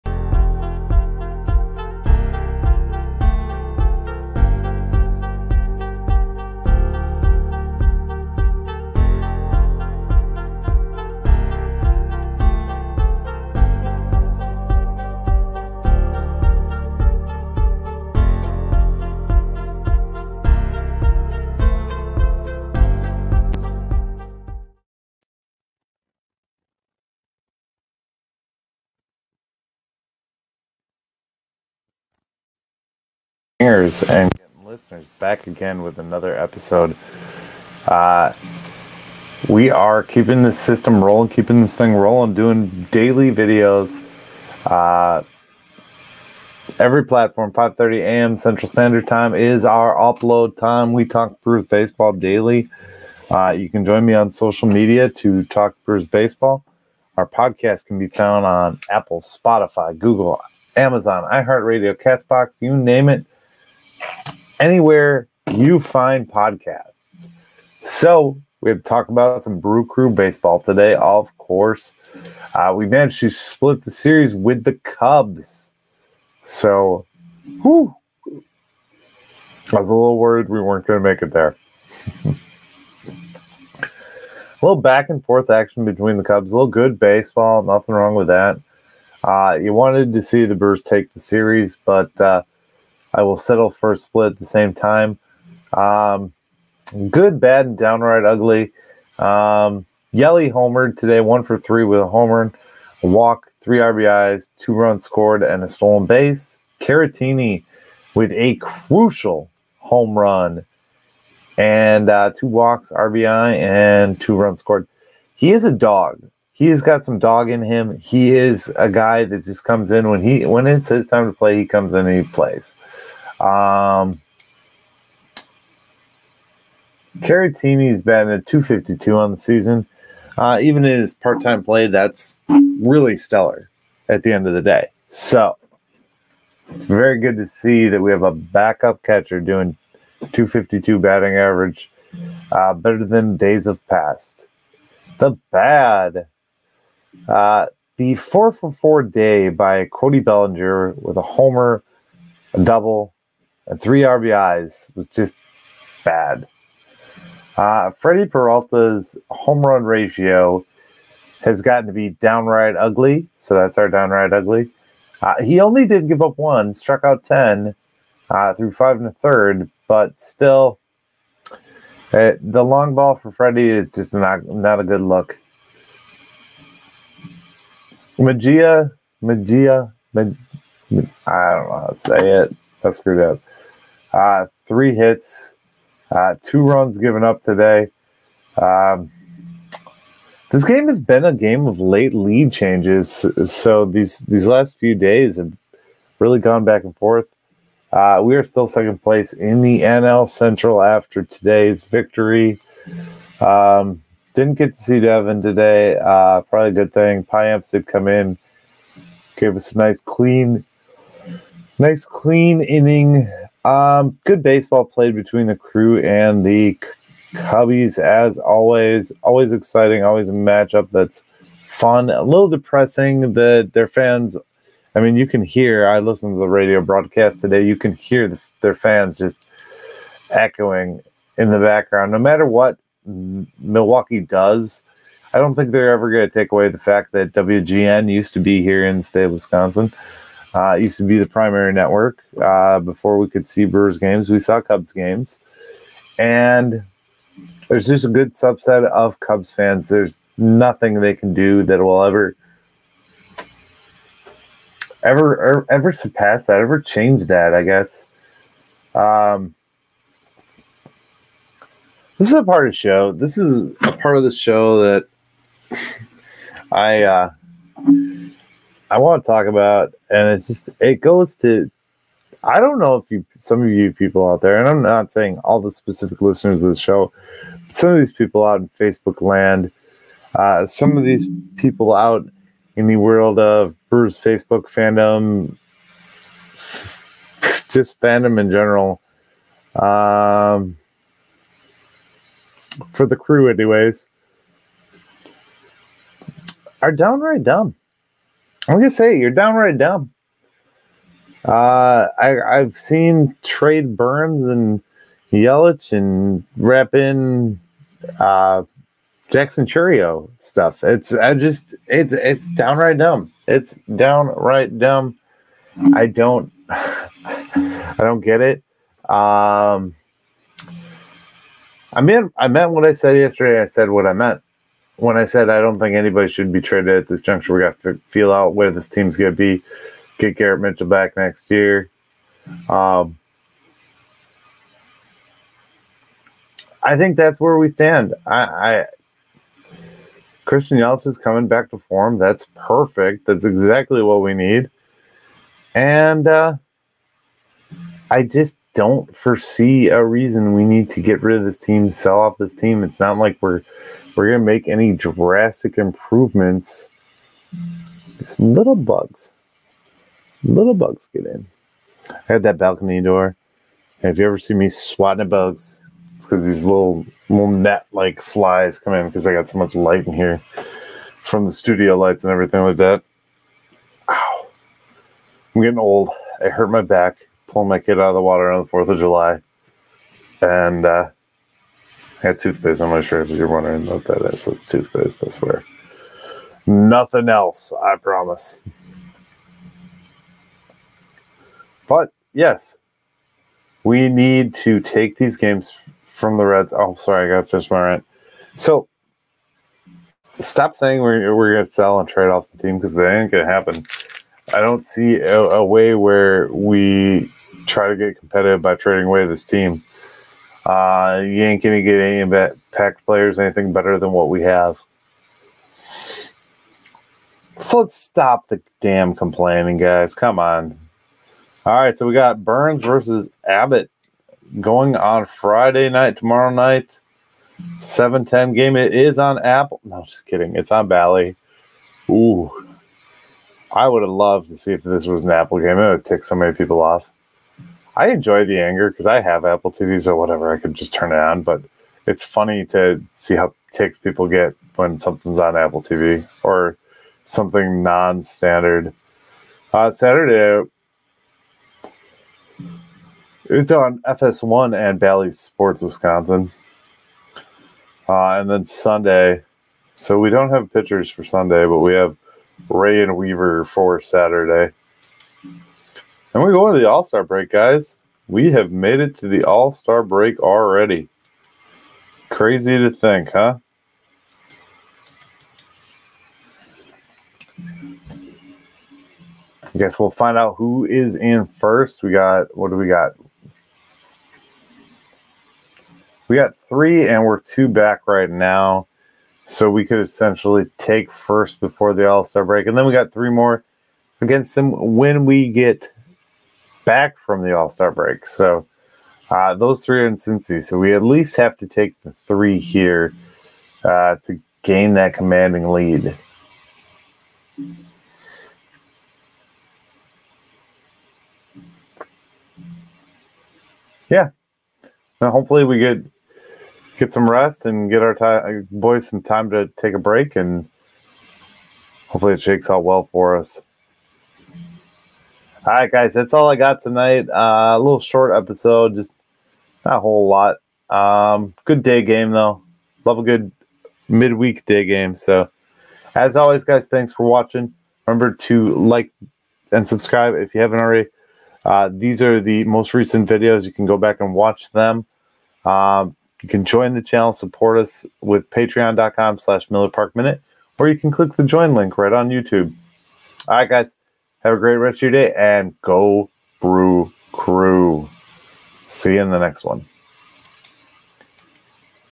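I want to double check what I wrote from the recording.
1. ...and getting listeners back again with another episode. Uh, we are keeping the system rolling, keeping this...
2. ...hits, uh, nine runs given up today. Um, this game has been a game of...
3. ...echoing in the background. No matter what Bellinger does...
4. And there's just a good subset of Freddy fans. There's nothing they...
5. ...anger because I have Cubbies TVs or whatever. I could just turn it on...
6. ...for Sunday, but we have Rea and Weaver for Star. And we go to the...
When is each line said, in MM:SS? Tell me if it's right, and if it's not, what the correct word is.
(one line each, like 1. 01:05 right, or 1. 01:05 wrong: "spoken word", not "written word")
1. 00:34 right
2. 03:04 wrong: "two", not "nine"
3. 03:50 wrong: "Milwaukee", not "Bellinger"
4. 04:06 wrong: "Cubs", not "Freddy"
5. 07:18 wrong: "Apple", not "Cubbies"
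6. 07:41 wrong: "Saturday", not "Star".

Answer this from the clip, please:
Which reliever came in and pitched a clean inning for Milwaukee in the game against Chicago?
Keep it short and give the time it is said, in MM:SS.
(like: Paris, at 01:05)
Payamps, at 03:27.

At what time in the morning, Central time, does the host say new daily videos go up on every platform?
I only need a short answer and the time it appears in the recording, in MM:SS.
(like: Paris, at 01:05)
5:30 a.m., at 00:47.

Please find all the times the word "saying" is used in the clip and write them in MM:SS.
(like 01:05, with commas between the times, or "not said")
04:35, 06:40.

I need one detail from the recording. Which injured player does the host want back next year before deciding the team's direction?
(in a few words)
Garrett Mitchell.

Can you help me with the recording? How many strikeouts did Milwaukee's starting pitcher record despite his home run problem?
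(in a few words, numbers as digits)
10.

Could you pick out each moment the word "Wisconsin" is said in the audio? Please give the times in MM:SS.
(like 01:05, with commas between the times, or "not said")
03:59, 07:35.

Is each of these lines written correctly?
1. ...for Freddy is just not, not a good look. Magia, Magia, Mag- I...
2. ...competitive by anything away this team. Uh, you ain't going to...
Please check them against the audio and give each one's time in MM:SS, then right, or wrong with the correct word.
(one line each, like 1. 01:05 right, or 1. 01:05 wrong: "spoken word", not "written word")
1. 02:53 right
2. 06:48 wrong: "trading", not "anything".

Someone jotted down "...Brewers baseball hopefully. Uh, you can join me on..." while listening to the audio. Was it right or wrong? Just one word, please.
wrong.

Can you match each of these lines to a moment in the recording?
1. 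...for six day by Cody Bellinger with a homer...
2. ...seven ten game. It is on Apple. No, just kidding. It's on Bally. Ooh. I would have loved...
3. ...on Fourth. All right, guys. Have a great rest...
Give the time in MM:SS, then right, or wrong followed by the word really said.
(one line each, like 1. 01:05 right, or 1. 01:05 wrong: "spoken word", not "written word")
1. 02:28 wrong: "four", not "six"
2. 07:07 right
3. 09:12 wrong: "YouTube", not "Fourth".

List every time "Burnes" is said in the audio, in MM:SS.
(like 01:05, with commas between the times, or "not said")
05:03, 07:02.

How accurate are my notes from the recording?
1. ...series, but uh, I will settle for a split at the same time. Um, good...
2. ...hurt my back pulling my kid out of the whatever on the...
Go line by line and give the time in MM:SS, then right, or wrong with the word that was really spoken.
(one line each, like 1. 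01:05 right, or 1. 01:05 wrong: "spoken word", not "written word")
1. 01:31 right
2. 06:16 wrong: "water", not "whatever".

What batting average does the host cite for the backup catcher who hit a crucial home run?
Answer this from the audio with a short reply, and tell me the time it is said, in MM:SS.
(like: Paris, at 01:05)
.252, at 02:20.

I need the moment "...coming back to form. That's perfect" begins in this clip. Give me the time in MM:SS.
05:41.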